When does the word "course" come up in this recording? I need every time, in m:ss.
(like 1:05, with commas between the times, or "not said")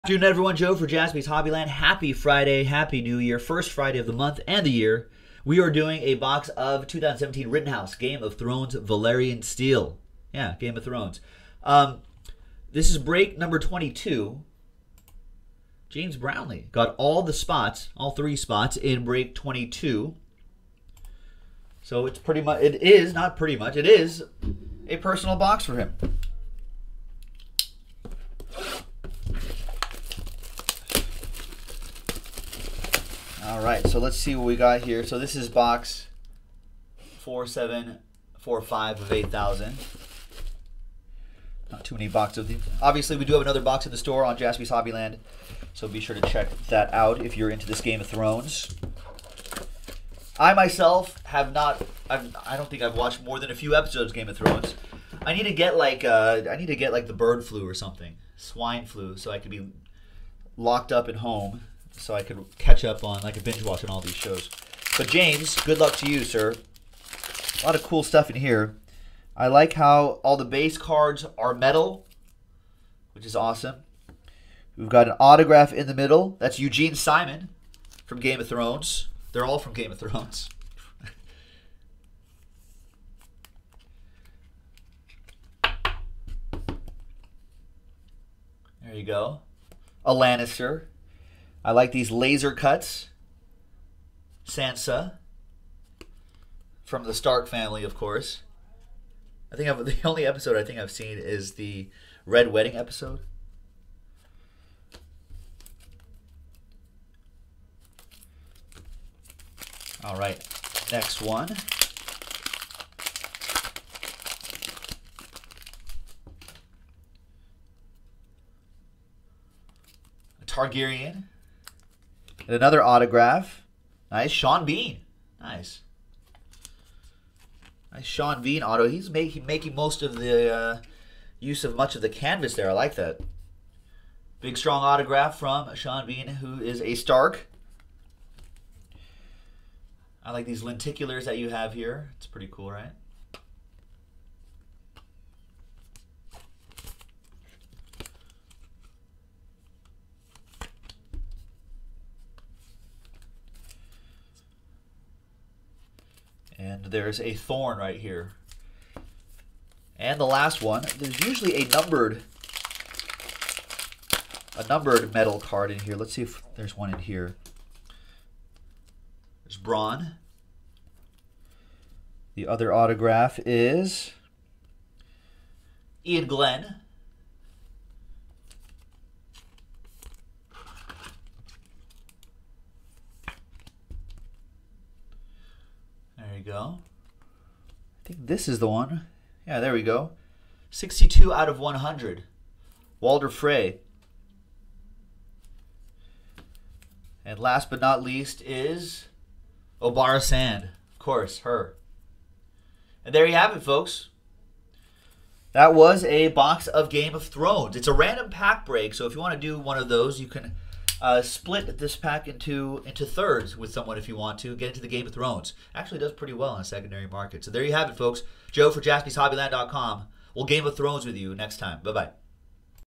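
1:37, 3:20.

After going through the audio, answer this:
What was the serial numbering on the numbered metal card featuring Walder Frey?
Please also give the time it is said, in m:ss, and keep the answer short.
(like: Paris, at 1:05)
62 out of 100, at 3:10.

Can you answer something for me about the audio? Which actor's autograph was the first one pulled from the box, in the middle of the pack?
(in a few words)
Eugene Simon.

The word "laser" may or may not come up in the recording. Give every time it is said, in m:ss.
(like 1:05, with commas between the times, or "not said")
1:32.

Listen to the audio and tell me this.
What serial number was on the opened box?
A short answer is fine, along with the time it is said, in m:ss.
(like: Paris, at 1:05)
4745, at 0:37.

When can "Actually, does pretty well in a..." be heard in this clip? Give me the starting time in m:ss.
3:35.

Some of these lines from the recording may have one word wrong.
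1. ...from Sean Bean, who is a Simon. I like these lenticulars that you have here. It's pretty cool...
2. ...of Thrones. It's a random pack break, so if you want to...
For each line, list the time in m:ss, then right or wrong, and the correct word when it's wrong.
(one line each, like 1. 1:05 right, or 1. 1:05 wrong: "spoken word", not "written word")
1. 2:15 wrong: "Stark", not "Simon"
2. 3:27 right.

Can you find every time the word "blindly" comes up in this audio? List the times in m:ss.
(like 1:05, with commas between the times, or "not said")
not said.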